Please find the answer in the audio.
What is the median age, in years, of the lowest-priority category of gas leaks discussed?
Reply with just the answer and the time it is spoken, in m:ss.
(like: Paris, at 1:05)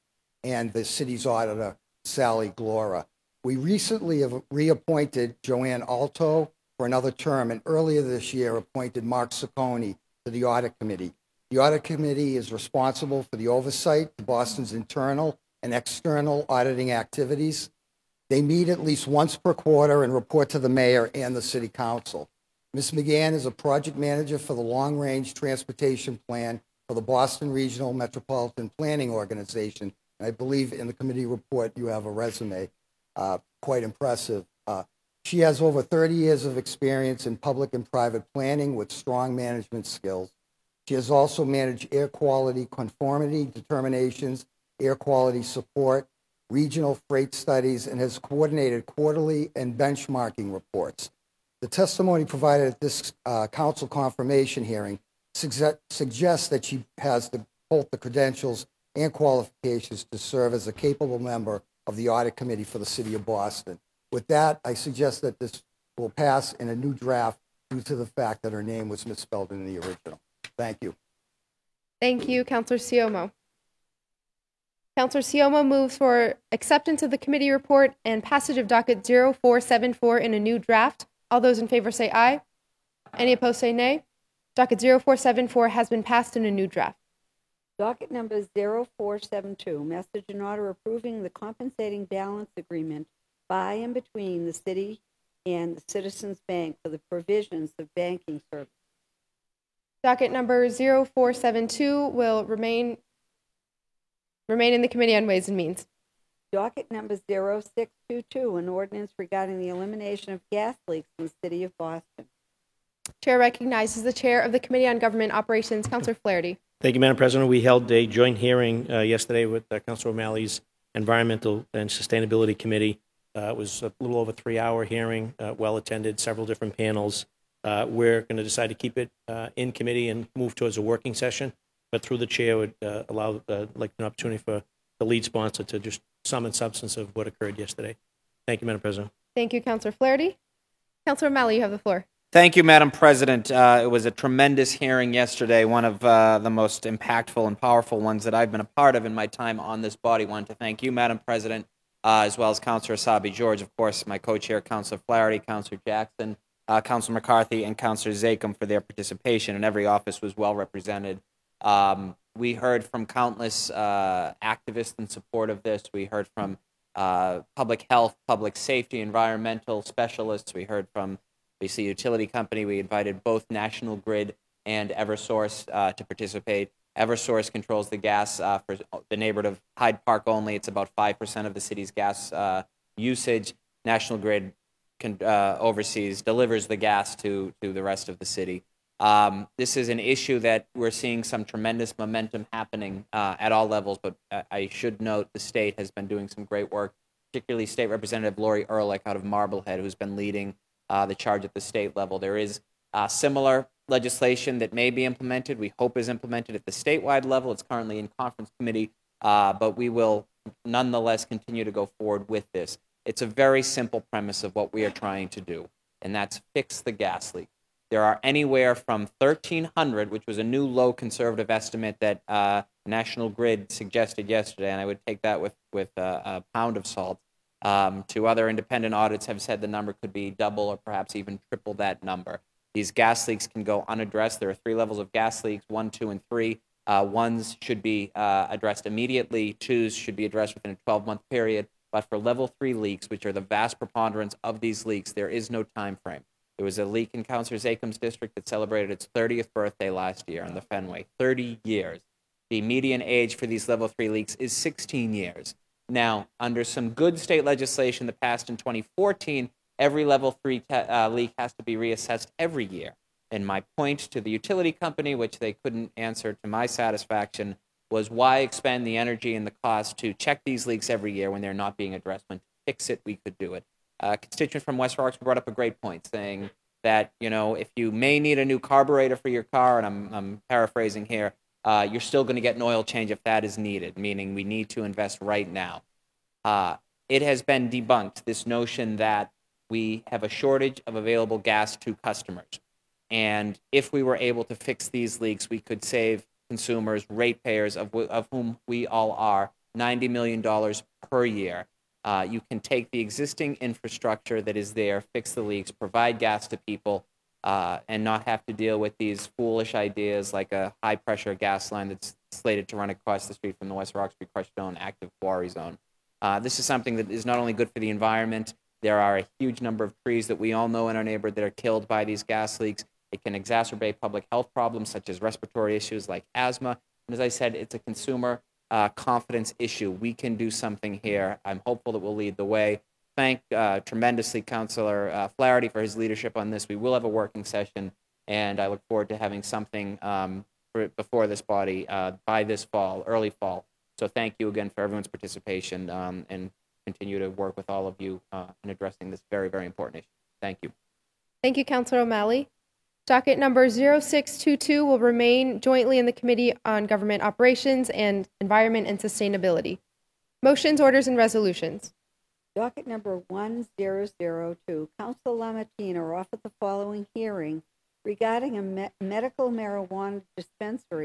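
16 years, at 4:14.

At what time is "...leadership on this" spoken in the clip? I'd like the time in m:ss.
5:35.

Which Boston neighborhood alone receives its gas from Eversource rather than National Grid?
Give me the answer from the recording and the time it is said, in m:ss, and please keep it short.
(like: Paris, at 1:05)
Hyde Park, at 2:59.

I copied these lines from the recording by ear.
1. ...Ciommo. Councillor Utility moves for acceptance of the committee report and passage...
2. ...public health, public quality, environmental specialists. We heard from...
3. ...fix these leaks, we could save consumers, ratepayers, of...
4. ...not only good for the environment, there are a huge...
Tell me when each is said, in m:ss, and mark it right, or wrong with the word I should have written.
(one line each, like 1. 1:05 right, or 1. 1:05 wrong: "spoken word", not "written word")
1. 1:12 wrong: "Ciommo", not "Utility"
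2. 2:47 wrong: "safety", not "quality"
3. 4:54 right
4. 5:17 right.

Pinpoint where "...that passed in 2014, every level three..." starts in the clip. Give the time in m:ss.
4:18.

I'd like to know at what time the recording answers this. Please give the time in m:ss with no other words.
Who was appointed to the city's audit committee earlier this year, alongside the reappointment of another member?
0:09.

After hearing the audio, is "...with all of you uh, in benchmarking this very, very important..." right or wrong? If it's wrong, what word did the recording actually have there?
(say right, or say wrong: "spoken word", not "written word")
wrong: "addressing", not "benchmarking".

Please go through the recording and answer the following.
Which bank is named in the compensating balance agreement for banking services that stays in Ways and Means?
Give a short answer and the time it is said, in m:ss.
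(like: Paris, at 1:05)
Citizens Bank, at 1:35.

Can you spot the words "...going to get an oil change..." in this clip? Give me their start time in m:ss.
4:42.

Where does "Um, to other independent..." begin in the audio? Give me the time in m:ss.
3:47.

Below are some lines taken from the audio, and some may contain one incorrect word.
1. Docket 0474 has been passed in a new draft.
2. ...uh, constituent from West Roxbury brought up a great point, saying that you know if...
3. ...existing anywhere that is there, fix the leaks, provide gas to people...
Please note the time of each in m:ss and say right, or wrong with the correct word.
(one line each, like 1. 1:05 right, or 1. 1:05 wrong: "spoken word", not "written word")
1. 1:24 right
2. 4:34 right
3. 5:02 wrong: "infrastructure", not "anywhere".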